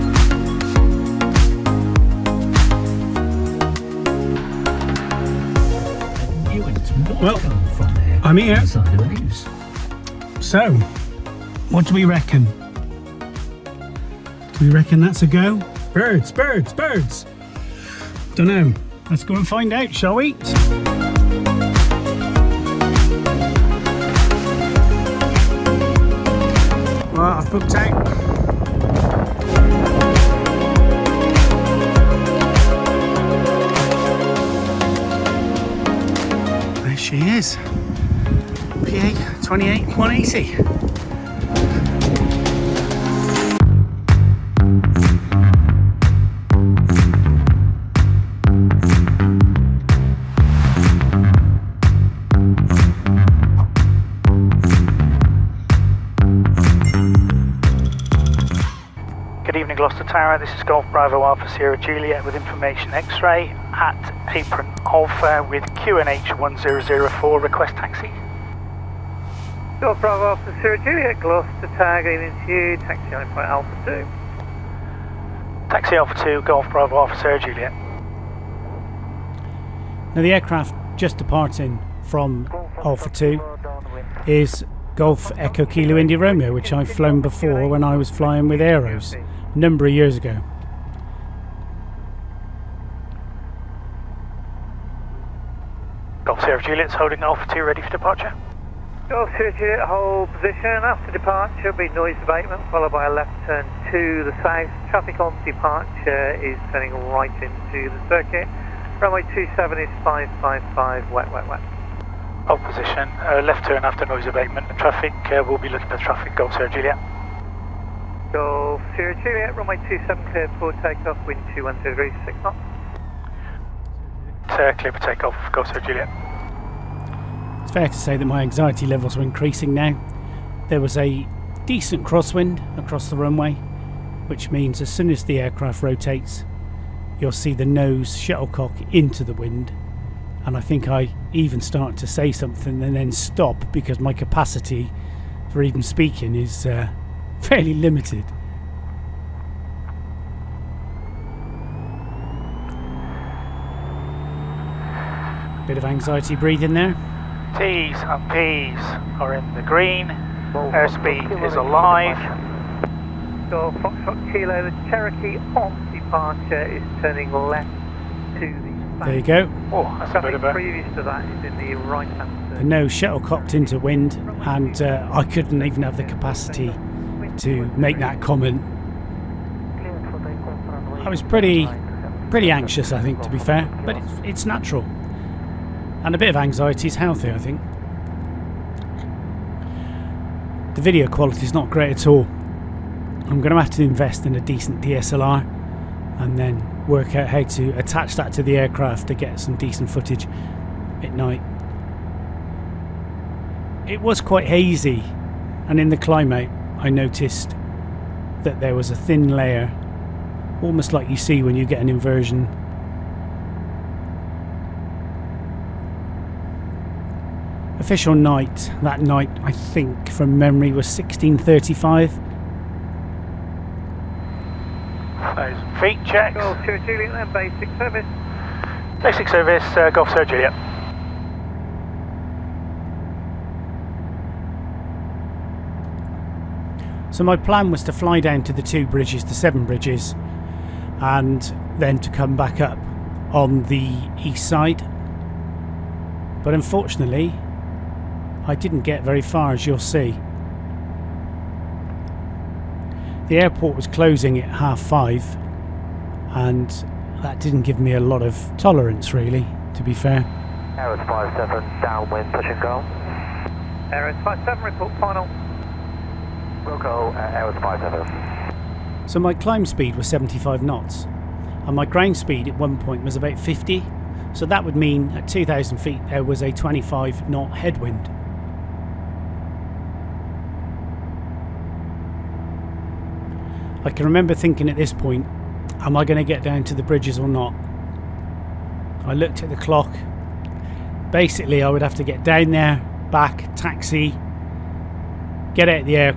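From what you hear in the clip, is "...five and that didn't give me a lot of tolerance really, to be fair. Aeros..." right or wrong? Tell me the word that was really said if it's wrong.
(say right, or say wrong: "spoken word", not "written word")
right.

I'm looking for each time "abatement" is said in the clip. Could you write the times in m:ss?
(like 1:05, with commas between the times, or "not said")
1:42, 1:54.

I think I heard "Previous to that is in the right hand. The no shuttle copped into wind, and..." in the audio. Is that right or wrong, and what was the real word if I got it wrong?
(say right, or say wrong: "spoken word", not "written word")
right.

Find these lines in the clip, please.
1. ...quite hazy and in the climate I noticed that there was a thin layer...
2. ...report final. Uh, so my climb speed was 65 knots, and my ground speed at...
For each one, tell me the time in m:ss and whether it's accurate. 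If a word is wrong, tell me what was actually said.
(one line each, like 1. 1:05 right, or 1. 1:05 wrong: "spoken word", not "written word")
1. 3:24 right
2. 4:24 wrong: "75", not "65".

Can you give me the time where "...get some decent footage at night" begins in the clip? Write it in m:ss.
3:19.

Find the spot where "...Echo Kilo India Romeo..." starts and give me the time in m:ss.
1:25.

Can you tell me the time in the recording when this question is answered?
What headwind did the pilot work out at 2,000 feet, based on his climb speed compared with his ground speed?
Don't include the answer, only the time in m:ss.
4:36.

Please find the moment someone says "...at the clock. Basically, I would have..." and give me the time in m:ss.
4:49.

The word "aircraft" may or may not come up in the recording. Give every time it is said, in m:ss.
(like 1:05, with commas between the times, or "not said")
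1:20, 2:15, 3:18.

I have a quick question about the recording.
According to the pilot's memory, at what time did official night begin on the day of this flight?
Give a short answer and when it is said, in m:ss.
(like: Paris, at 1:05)
1635, at 3:40.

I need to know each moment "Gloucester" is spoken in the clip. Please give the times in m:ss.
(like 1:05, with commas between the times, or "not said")
0:59, 1:11.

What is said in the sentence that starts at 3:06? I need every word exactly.
And a bit of anxiety is healthy, I think.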